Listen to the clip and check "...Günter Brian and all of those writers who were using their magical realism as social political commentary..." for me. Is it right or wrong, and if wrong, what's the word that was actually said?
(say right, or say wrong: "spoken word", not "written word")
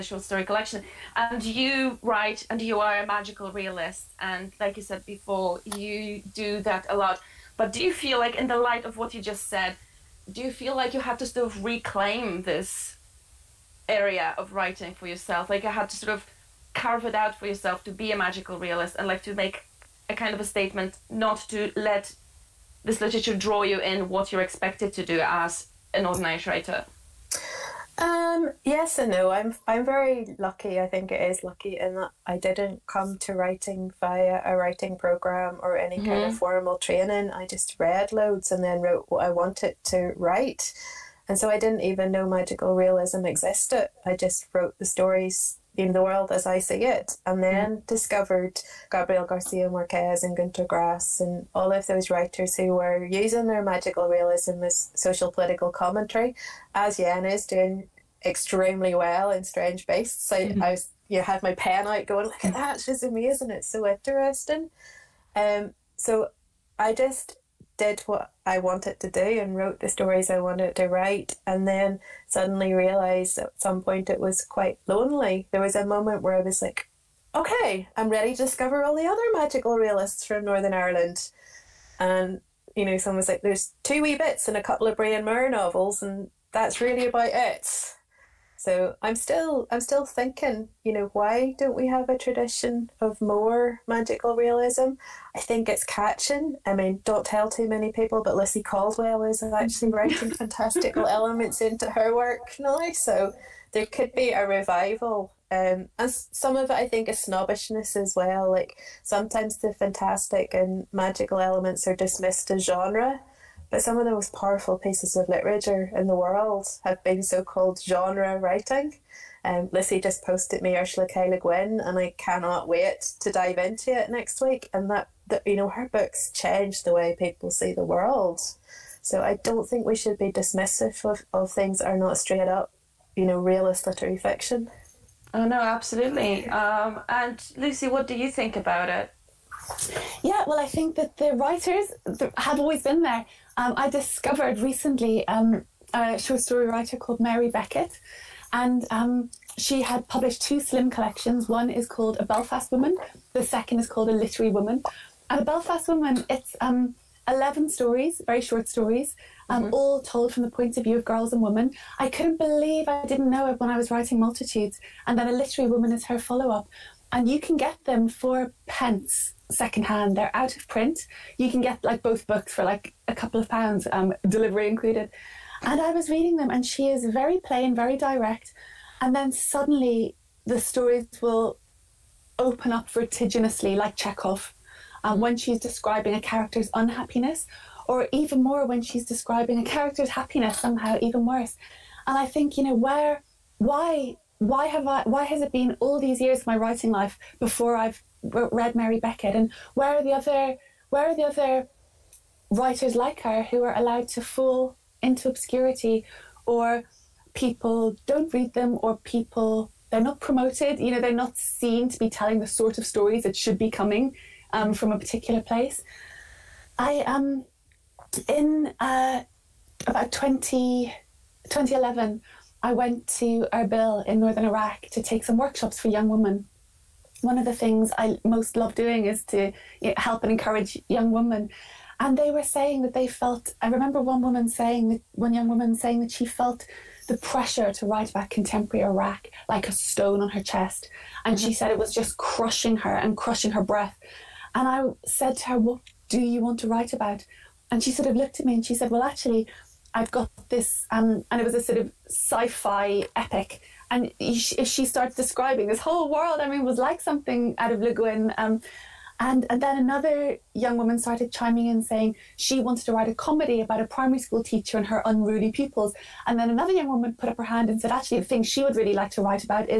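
wrong: "Grass", not "Brian".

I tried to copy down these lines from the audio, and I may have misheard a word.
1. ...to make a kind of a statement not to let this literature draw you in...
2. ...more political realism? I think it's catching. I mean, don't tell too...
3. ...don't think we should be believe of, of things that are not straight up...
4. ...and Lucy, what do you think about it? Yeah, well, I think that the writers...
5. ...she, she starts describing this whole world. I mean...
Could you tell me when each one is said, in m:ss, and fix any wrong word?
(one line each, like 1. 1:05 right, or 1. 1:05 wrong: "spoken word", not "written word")
1. 0:19 right
2. 1:33 wrong: "magical", not "political"
3. 2:09 wrong: "dismissive", not "believe"
4. 2:17 right
5. 4:14 right.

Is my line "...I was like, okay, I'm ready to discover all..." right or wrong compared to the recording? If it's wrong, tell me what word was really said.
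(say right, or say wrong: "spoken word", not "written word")
right.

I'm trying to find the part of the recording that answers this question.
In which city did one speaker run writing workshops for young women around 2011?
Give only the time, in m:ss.
3:43.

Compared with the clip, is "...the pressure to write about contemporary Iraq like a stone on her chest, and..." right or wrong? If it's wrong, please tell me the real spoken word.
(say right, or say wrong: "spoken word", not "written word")
right.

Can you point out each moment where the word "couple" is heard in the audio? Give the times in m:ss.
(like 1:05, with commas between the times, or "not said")
1:24, 2:53.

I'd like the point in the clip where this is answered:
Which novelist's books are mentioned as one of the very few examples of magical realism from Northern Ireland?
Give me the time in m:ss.
1:24.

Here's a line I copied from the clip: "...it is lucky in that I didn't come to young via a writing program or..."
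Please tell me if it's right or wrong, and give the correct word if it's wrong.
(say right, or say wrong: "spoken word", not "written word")
wrong: "writing", not "young".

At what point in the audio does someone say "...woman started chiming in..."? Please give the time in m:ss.
4:20.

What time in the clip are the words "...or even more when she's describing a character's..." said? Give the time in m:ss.
3:07.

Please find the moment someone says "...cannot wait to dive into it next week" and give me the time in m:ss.
2:02.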